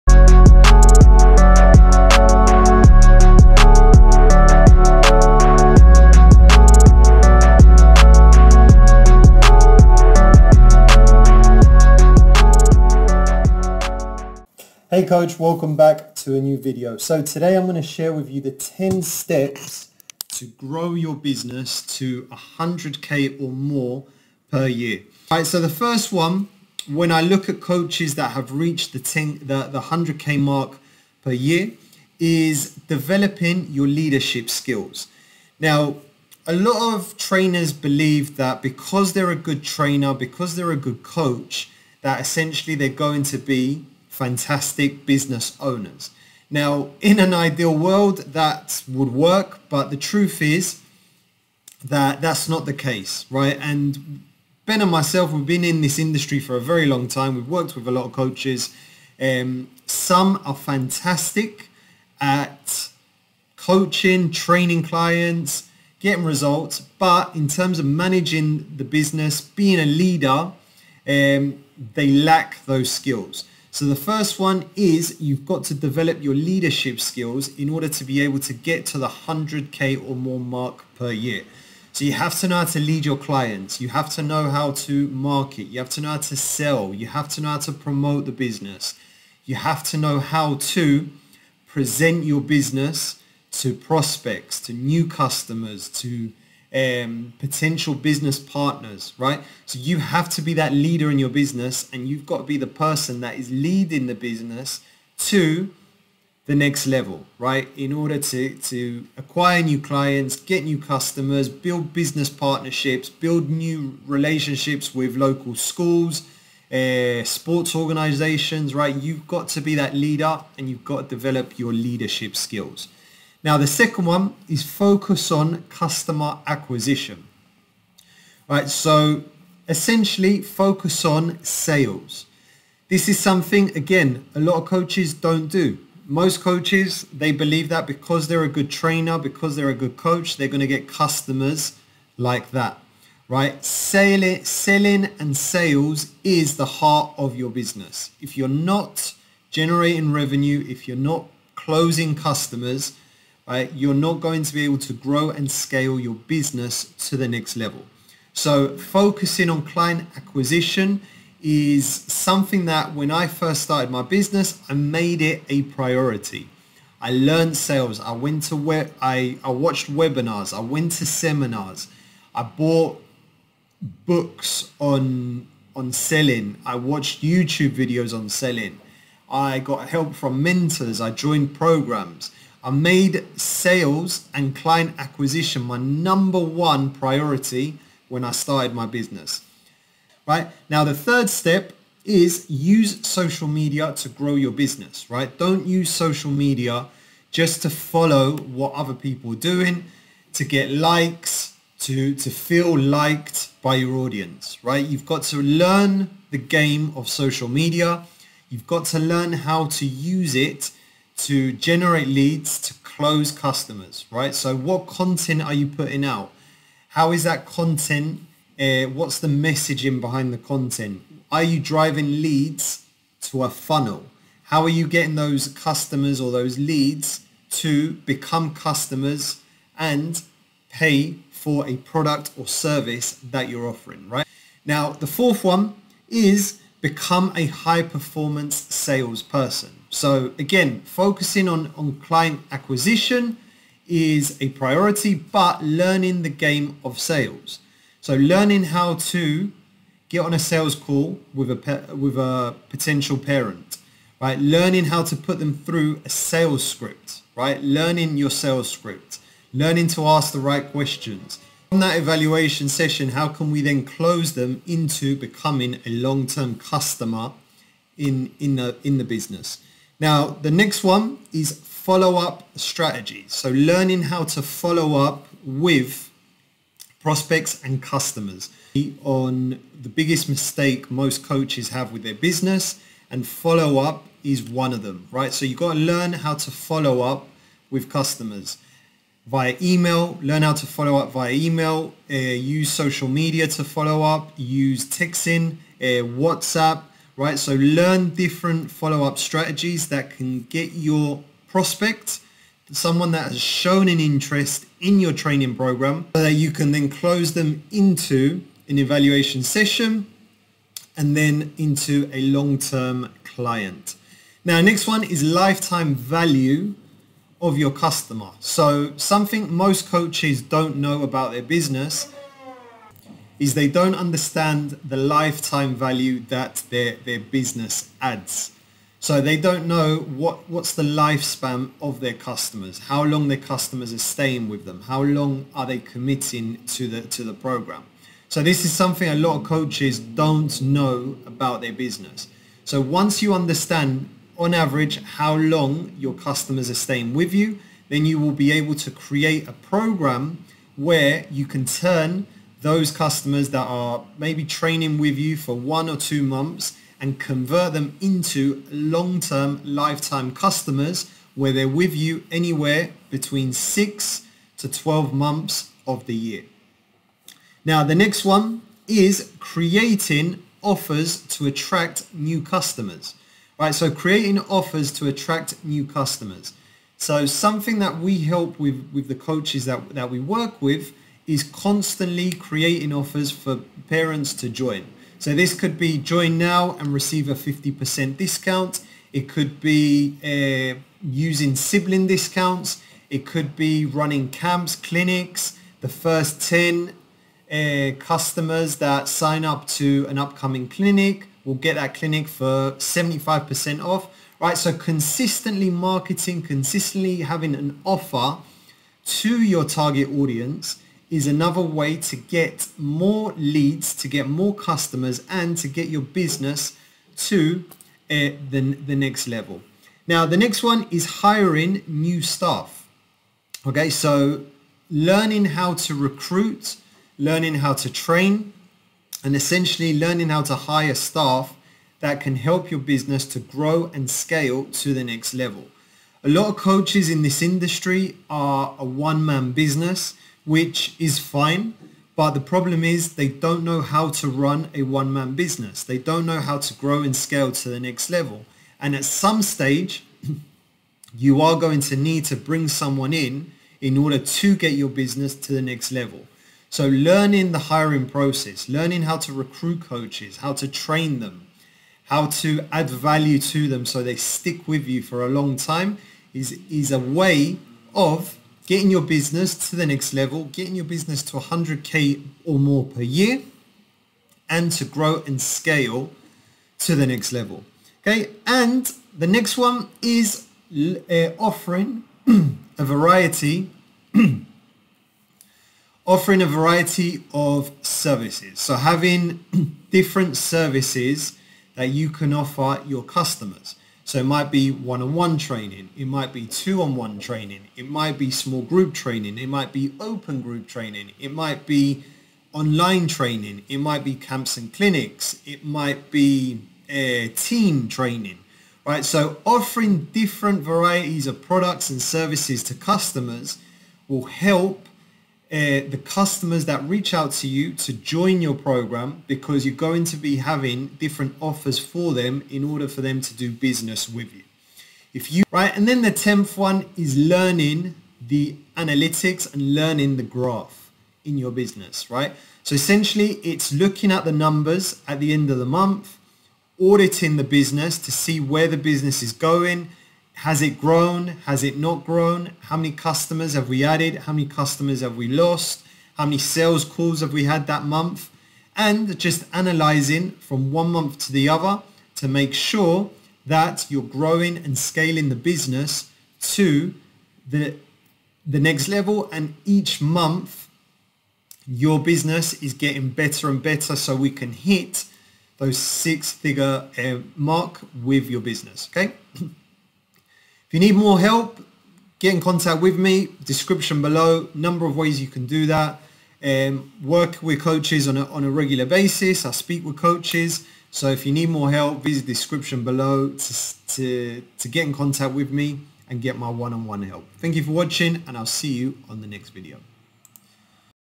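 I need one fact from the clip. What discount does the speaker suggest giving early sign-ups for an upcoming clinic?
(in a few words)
75% off.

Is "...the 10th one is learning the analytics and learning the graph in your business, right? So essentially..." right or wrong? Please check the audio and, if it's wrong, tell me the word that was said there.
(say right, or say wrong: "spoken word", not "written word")
right.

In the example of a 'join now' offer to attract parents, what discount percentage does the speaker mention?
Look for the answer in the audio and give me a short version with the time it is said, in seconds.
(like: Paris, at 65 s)
50%, at 387 s.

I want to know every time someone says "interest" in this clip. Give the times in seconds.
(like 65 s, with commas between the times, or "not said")
303 s.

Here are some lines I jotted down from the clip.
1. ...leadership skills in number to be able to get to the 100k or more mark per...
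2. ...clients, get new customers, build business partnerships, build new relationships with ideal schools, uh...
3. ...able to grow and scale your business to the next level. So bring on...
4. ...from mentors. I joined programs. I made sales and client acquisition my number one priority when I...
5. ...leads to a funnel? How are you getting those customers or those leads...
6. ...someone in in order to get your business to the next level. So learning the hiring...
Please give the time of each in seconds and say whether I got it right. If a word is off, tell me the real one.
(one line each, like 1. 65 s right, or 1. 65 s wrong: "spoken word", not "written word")
1. 76 s wrong: "order", not "number"
2. 109 s wrong: "local", not "ideal"
3. 154 s wrong: "focusing", not "bring"
4. 180 s right
5. 222 s right
6. 452 s right.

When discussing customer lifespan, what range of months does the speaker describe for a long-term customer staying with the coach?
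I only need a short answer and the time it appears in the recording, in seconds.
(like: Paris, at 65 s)
6 to 12 months, at 363 s.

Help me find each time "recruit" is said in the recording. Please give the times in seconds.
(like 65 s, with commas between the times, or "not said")
425 s, 459 s.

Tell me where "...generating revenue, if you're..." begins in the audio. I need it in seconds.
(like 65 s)
149 s.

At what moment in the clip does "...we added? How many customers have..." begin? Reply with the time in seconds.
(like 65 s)
543 s.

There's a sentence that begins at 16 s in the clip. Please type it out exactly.
So today I'm going to share with you the 10 steps to grow your business to 100k or more per year.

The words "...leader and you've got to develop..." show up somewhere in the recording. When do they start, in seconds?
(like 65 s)
119 s.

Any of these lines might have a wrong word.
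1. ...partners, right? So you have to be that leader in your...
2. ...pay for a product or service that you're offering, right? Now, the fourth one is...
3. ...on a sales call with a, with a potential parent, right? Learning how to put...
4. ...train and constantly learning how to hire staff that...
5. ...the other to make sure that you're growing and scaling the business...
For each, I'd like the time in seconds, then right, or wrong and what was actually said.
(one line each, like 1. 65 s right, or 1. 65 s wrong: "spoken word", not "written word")
1. 98 s right
2. 230 s right
3. 250 s right
4. 427 s wrong: "essentially", not "constantly"
5. 551 s right.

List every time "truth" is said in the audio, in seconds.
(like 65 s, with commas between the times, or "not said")
50 s.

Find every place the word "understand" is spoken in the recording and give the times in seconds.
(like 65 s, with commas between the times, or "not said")
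323 s, 343 s.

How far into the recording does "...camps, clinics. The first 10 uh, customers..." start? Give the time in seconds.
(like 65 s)
394 s.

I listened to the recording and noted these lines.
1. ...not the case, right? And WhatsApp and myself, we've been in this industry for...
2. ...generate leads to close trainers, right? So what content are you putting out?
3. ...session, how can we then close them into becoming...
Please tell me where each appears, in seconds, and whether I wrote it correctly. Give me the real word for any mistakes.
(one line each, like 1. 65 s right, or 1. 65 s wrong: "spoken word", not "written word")
1. 52 s wrong: "Ben", not "WhatsApp"
2. 211 s wrong: "customers", not "trainers"
3. 262 s right.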